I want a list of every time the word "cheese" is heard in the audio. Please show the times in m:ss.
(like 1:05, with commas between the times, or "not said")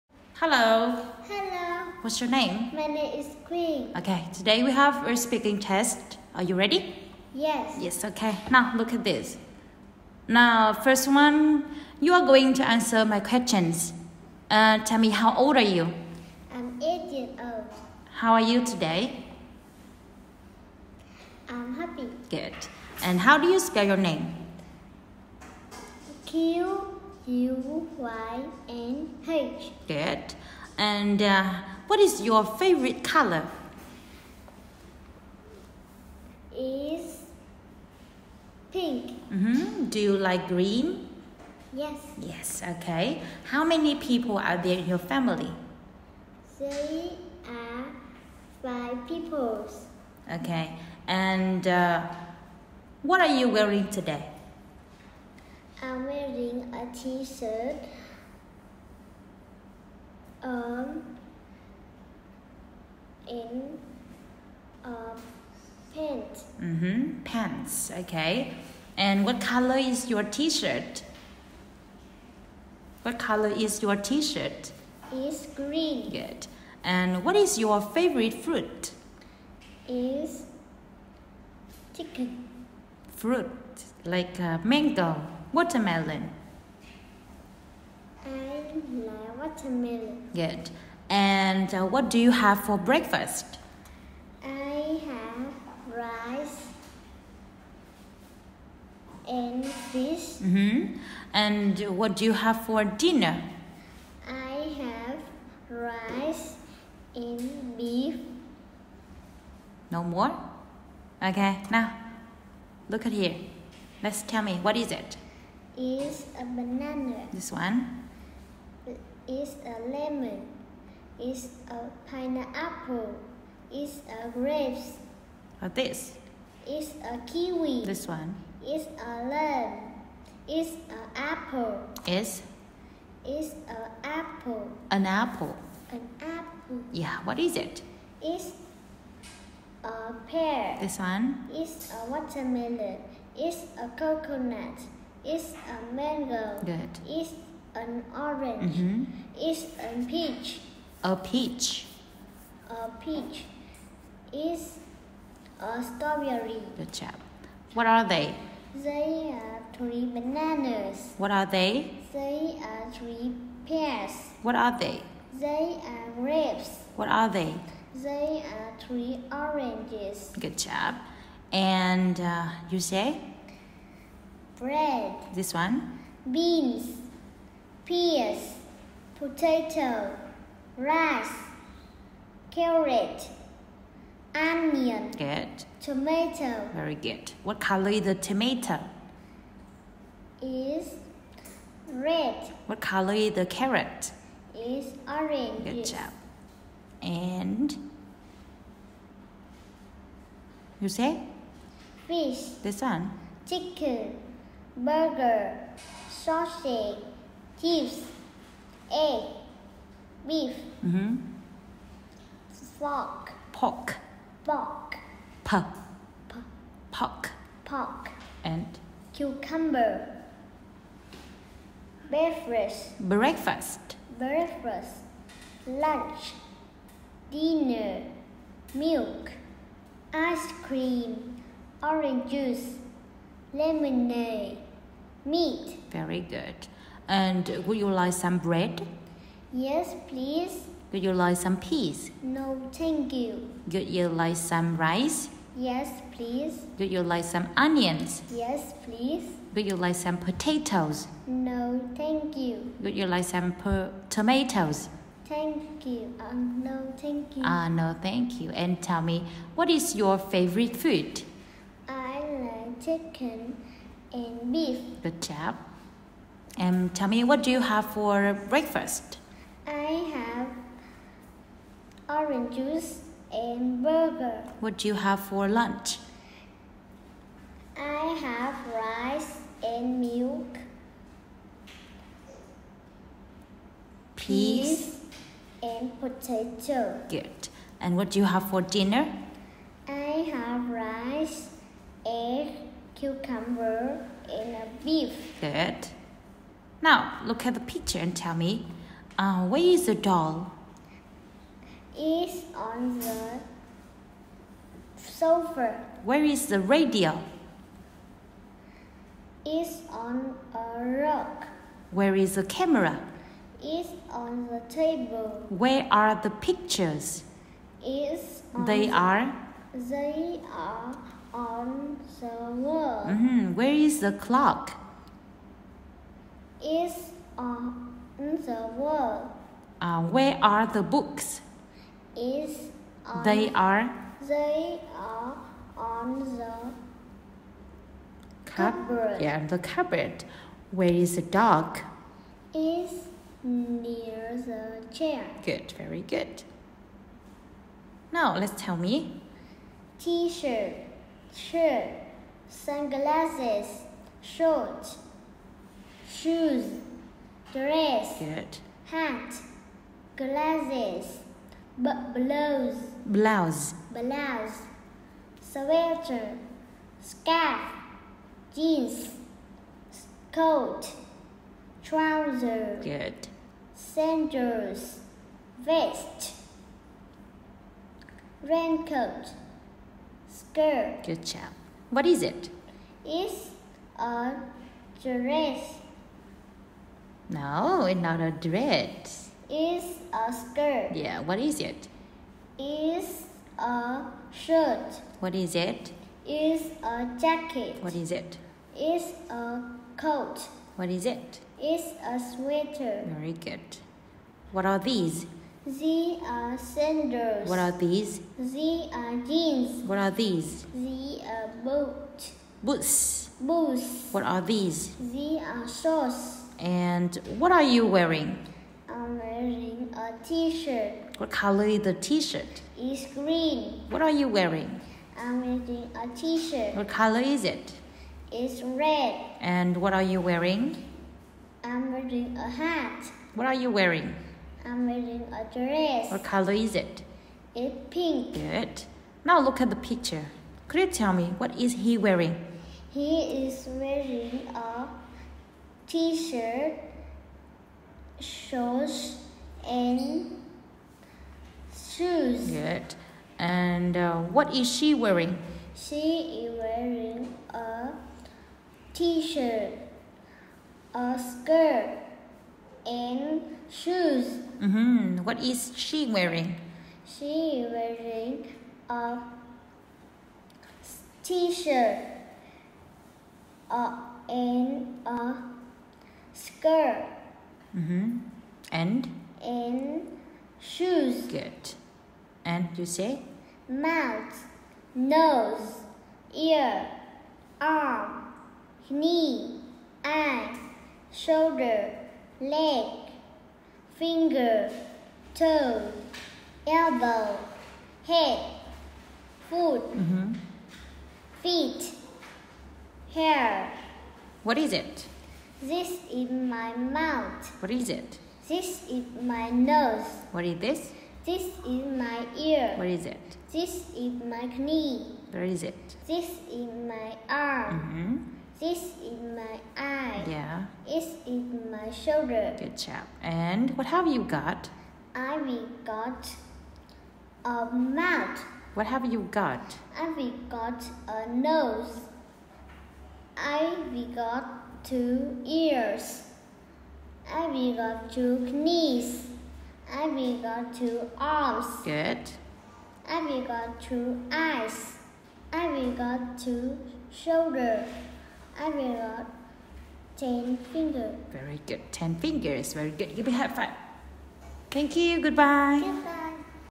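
3:27.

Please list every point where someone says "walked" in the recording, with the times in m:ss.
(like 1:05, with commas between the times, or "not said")
not said.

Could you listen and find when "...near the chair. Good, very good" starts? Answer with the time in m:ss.
5:43.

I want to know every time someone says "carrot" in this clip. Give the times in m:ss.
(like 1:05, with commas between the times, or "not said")
3:02, 3:13.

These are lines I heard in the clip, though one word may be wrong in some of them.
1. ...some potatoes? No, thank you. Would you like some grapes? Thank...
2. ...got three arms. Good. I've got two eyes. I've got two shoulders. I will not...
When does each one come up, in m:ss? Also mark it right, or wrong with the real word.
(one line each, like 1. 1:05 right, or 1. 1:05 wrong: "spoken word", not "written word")
1. 4:09 wrong: "tomatoes", not "grapes"
2. 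9:00 wrong: "two", not "three".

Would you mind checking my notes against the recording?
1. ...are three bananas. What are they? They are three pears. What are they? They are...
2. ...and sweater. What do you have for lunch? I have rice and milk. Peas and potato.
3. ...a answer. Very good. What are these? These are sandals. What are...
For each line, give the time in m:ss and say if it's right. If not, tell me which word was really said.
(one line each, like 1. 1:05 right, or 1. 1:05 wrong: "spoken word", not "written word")
1. 2:39 right
2. 4:33 wrong: "burger", not "sweater"
3. 6:42 wrong: "sweater", not "answer".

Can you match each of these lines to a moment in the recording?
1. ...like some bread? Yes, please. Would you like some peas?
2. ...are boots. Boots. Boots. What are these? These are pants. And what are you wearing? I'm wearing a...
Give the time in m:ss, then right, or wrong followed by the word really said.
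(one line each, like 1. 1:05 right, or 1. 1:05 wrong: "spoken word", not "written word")
1. 3:57 right
2. 6:51 wrong: "shorts", not "pants".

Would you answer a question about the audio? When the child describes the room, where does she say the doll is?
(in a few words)
On the sofa.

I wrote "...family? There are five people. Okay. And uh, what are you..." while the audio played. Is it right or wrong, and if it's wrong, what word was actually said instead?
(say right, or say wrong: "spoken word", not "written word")
right.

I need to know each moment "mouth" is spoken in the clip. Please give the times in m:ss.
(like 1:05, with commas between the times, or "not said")
8:03, 8:26, 8:47.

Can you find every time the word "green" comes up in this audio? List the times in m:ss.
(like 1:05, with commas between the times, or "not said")
0:40, 1:15, 7:03.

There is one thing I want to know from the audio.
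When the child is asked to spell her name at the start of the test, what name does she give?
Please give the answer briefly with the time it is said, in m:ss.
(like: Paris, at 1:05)
Quỳnh, at 0:03.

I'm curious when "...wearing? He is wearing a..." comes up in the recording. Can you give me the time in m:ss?
7:21.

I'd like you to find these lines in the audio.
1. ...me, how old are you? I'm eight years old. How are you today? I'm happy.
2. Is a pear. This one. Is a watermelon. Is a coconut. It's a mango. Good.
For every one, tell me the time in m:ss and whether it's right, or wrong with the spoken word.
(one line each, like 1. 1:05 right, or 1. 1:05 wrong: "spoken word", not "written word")
1. 0:14 right
2. 2:18 right.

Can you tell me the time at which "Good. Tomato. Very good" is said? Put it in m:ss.
3:05.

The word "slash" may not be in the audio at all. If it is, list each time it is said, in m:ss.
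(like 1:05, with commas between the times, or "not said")
not said.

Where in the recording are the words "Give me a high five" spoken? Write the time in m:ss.
9:13.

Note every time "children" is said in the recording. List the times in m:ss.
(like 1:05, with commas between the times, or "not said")
not said.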